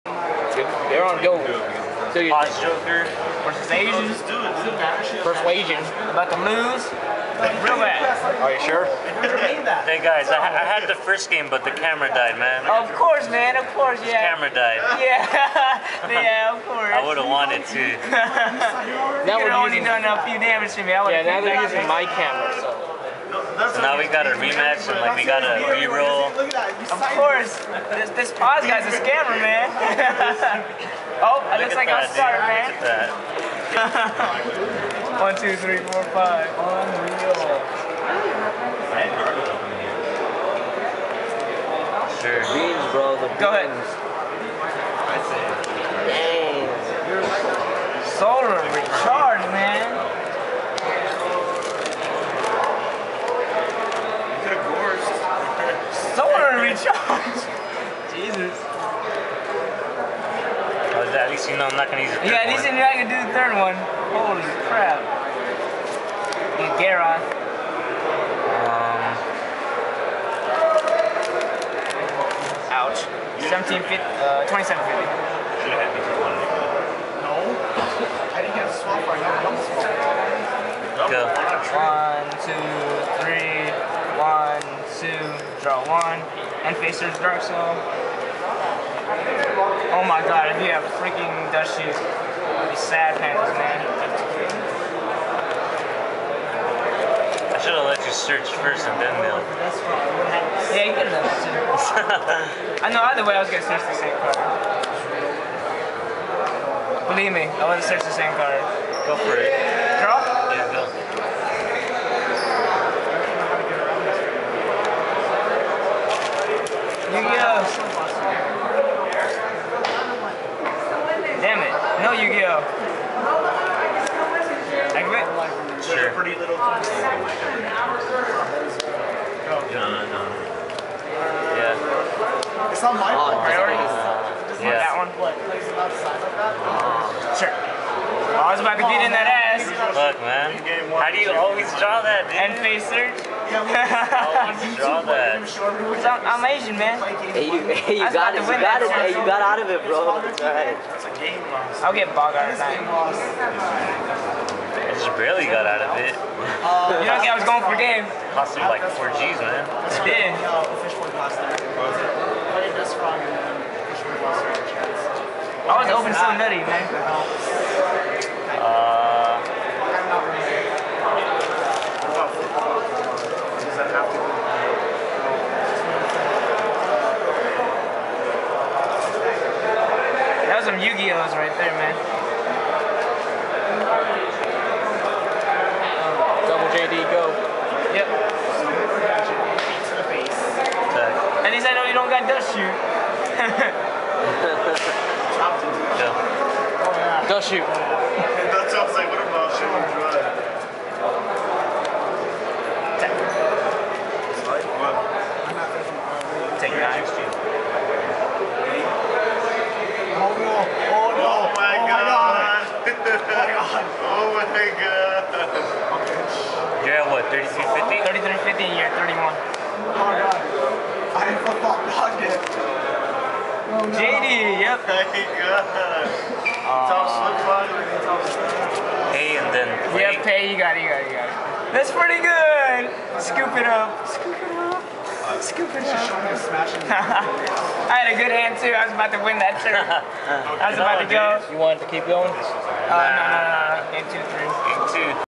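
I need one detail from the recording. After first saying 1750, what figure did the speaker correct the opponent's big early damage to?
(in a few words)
2750.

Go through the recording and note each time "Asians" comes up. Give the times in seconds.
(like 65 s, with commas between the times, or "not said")
3 s, 146 s.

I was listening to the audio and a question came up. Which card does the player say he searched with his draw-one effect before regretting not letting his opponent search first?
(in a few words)
Dark Soul.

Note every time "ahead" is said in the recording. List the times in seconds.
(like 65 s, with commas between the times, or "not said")
43 s.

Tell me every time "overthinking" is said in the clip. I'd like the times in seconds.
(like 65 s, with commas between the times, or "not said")
not said.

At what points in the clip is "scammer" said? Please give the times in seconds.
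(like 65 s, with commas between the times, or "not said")
29 s.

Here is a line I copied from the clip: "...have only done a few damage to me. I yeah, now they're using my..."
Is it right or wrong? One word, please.
right.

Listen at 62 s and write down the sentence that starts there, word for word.
you're not going to do the third one.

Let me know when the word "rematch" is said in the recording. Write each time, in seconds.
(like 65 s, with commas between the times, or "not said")
24 s.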